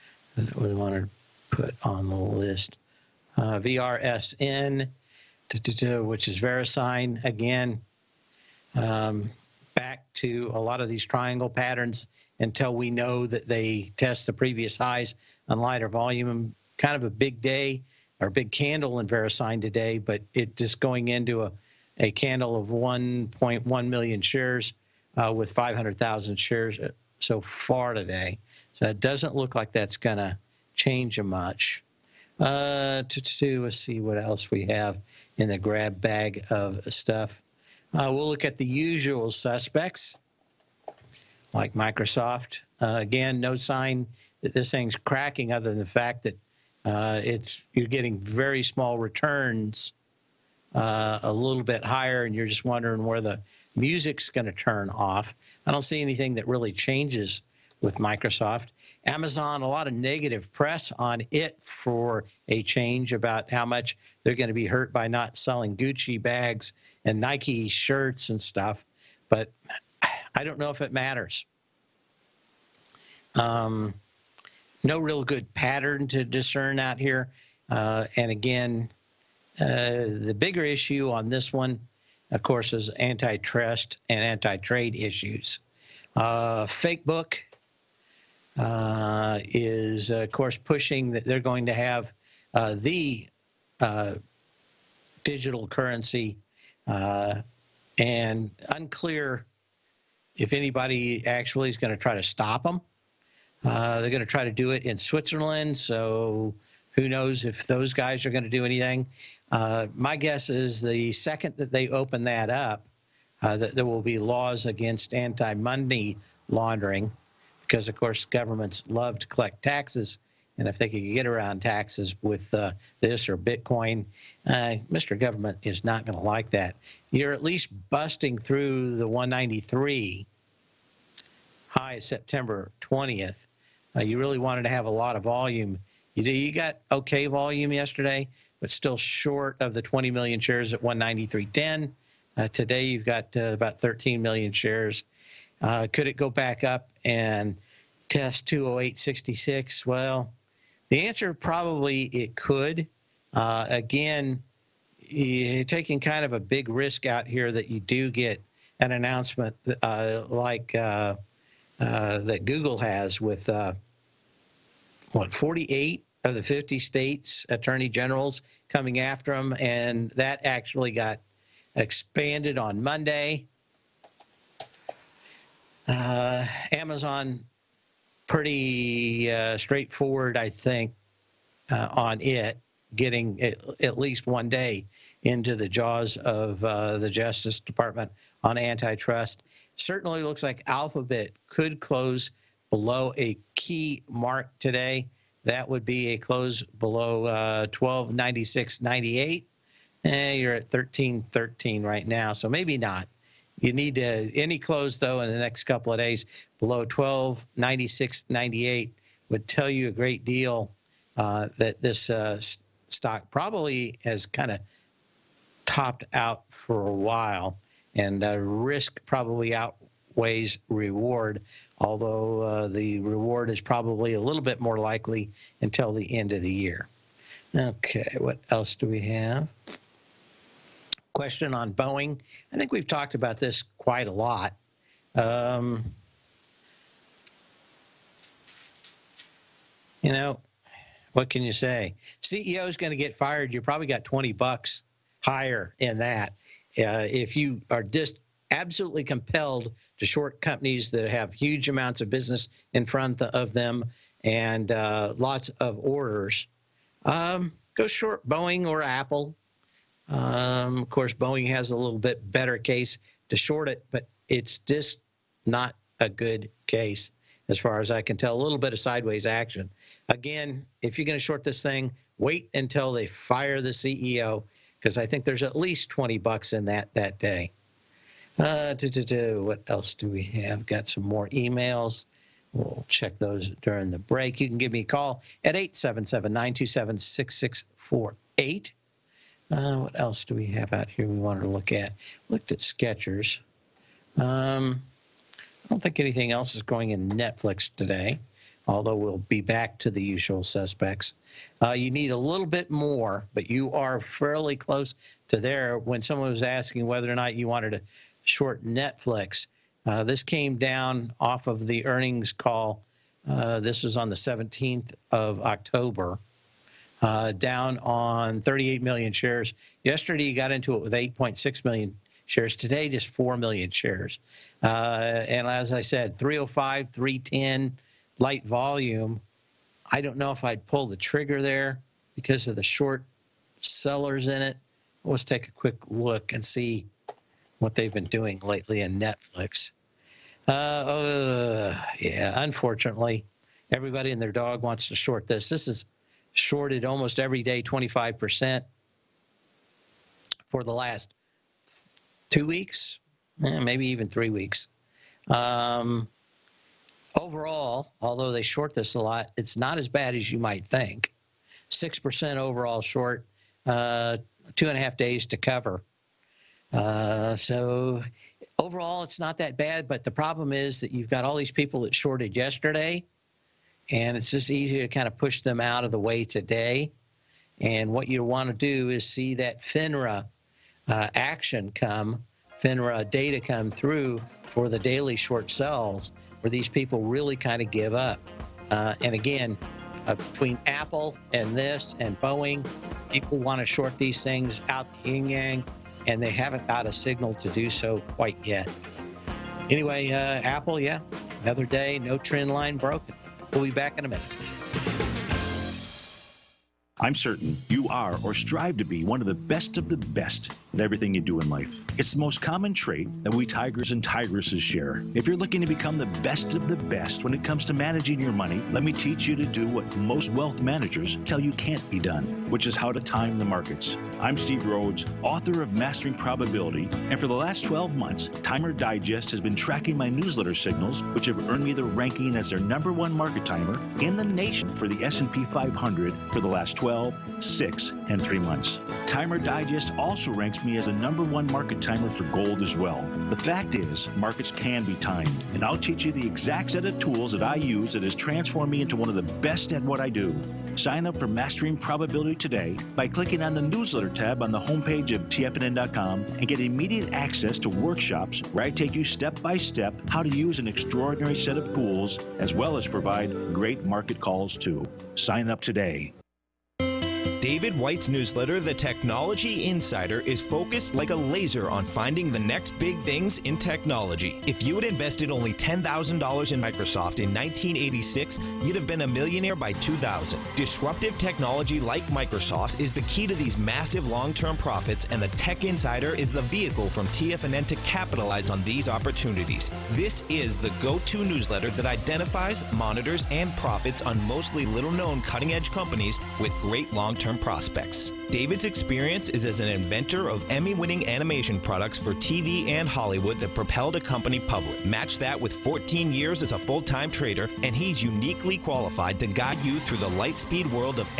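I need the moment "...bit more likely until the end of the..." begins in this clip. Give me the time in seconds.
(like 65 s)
224 s.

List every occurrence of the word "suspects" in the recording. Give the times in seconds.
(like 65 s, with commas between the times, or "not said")
39 s, 300 s.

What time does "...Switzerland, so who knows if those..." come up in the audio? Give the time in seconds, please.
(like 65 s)
104 s.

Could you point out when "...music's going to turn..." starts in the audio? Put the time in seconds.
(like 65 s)
53 s.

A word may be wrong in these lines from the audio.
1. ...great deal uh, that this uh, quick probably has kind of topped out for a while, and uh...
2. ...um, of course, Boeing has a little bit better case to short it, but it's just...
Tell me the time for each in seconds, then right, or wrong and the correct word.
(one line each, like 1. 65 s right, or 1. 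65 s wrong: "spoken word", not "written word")
1. 209 s wrong: "stock", not "quick"
2. 260 s right.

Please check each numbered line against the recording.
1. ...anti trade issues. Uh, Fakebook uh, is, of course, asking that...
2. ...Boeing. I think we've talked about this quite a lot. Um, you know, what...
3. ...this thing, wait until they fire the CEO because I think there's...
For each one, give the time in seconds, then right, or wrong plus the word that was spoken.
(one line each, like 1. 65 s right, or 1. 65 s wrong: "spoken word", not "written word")
1. 84 s wrong: "pushing", not "asking"
2. 231 s right
3. 271 s right.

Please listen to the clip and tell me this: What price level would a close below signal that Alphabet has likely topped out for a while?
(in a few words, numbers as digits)
1296.98.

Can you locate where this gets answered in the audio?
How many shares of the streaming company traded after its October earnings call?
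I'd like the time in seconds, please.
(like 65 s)
318 s.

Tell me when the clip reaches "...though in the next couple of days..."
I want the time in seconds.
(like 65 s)
204 s.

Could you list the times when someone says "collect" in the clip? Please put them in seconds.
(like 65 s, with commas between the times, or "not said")
119 s.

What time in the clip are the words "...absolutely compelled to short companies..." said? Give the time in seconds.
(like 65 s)
248 s.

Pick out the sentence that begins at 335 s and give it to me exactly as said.
Let's take a quick look and see what they've been doing lately in Netflix.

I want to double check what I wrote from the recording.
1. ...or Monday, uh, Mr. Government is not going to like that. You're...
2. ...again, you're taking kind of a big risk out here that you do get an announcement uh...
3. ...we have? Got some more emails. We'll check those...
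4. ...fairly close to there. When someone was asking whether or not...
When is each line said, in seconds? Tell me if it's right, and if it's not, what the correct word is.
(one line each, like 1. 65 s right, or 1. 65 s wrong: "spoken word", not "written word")
1. 123 s wrong: "Bitcoin", not "Monday"
2. 153 s right
3. 280 s right
4. 304 s right.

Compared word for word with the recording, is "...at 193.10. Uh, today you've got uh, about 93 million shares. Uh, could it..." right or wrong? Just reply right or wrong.
wrong.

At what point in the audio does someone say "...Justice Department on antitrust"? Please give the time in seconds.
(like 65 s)
187 s.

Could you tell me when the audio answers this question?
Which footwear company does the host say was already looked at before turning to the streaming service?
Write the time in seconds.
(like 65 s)
292 s.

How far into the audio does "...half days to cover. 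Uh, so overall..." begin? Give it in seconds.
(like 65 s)
364 s.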